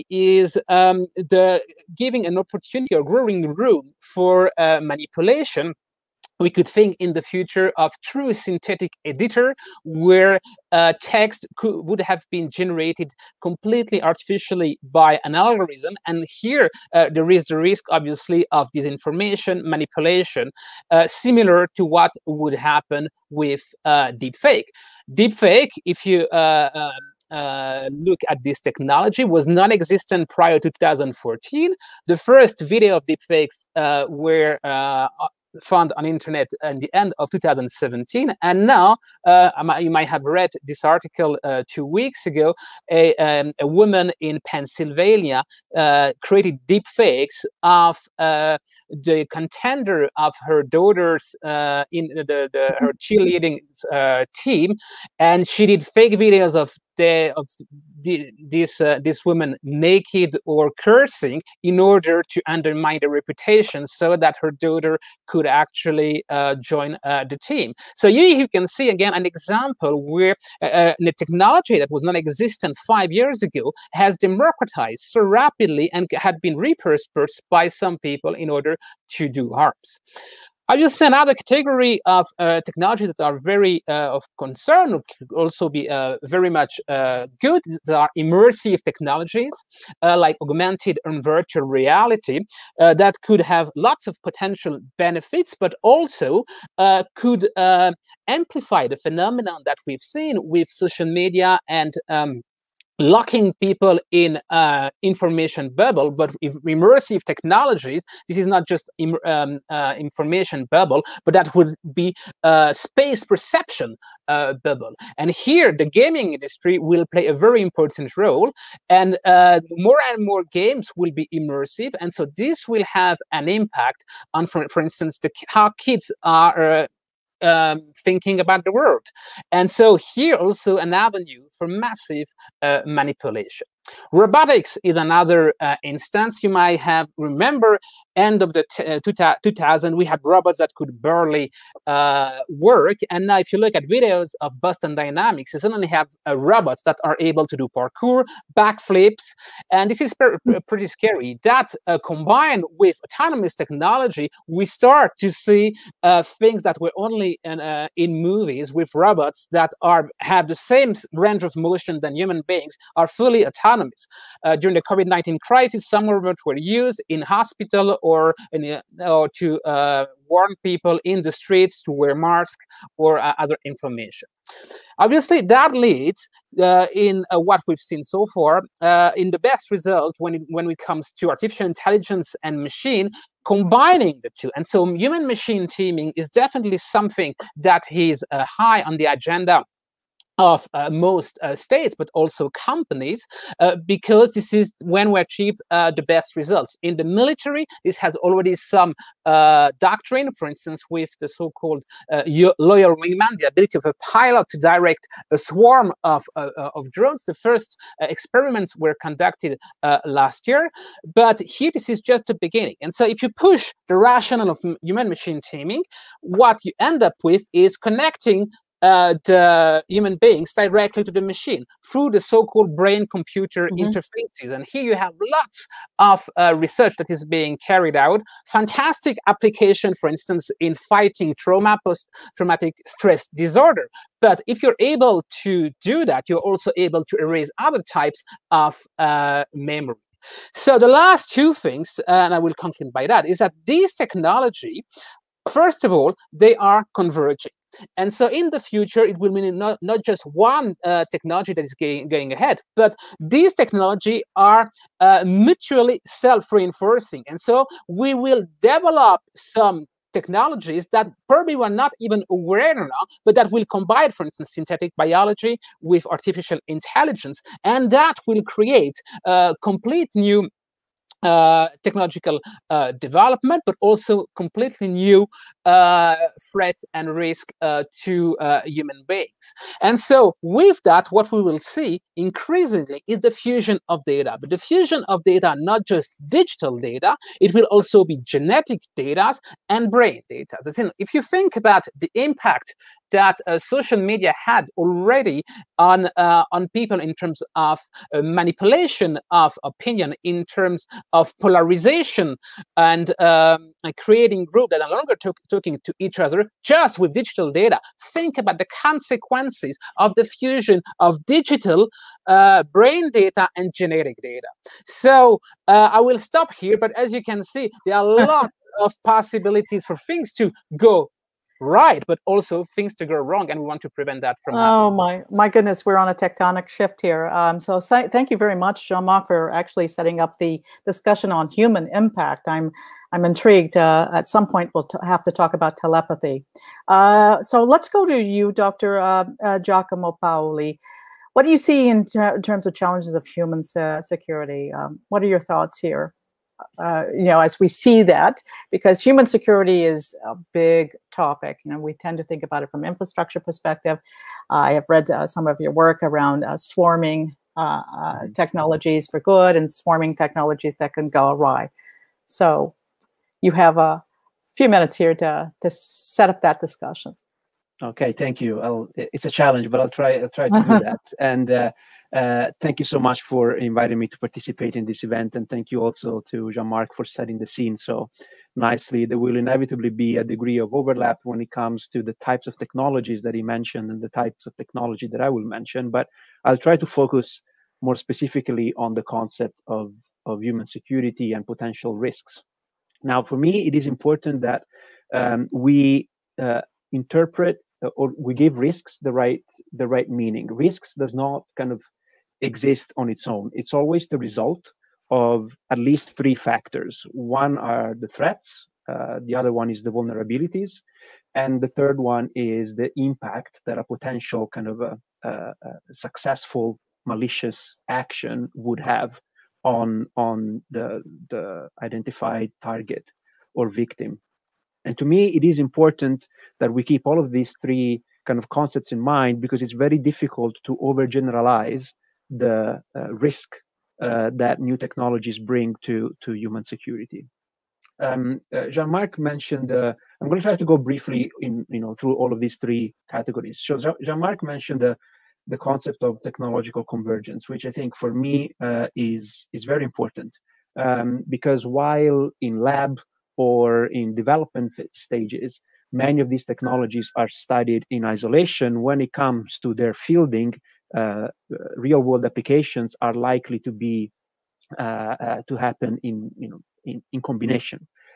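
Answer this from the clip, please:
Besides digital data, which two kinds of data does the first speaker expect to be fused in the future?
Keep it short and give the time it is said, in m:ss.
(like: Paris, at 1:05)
genetic data and brain data, at 4:48.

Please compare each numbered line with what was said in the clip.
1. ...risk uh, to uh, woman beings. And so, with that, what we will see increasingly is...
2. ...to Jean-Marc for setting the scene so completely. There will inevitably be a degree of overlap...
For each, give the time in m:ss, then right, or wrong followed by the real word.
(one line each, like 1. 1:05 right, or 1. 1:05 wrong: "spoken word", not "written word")
1. 4:37 wrong: "human", not "woman"
2. 6:16 wrong: "nicely", not "completely".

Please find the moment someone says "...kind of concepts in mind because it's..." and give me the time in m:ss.
7:08.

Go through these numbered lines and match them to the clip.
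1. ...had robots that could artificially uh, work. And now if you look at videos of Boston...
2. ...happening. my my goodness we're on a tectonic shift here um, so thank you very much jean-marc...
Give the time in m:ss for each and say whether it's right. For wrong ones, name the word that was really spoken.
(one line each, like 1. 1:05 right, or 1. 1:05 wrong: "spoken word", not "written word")
1. 2:20 wrong: "barely", not "artificially"
2. 5:24 right.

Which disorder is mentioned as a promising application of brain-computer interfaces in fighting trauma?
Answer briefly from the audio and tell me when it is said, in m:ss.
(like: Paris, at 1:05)
post-traumatic stress disorder, at 3:51.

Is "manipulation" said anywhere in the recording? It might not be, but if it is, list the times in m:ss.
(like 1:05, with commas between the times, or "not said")
0:04, 0:19, 2:12, 4:58.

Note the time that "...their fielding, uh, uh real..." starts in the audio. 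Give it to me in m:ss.
7:39.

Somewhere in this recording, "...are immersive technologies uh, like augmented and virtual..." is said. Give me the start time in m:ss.
1:27.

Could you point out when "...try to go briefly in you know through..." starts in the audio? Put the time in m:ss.
7:20.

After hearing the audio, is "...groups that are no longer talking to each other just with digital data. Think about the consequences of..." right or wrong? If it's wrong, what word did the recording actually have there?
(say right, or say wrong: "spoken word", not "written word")
right.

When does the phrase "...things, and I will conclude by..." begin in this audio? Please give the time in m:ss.
4:01.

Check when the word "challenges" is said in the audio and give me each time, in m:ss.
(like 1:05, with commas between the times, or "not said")
5:42, 6:09.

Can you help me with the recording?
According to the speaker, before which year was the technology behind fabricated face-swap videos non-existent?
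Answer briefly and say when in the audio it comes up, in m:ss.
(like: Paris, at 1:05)
2014, at 0:30.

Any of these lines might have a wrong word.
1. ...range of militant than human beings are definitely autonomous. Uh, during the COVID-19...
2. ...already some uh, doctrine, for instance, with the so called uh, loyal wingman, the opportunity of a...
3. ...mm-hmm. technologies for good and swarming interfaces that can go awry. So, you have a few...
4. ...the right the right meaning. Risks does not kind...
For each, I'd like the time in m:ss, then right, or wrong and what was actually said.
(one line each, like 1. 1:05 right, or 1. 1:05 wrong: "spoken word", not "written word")
1. 2:41 wrong: "fully", not "definitely"
2. 3:18 wrong: "ability", not "opportunity"
3. 5:57 wrong: "technologies", not "interfaces"
4. 6:39 right.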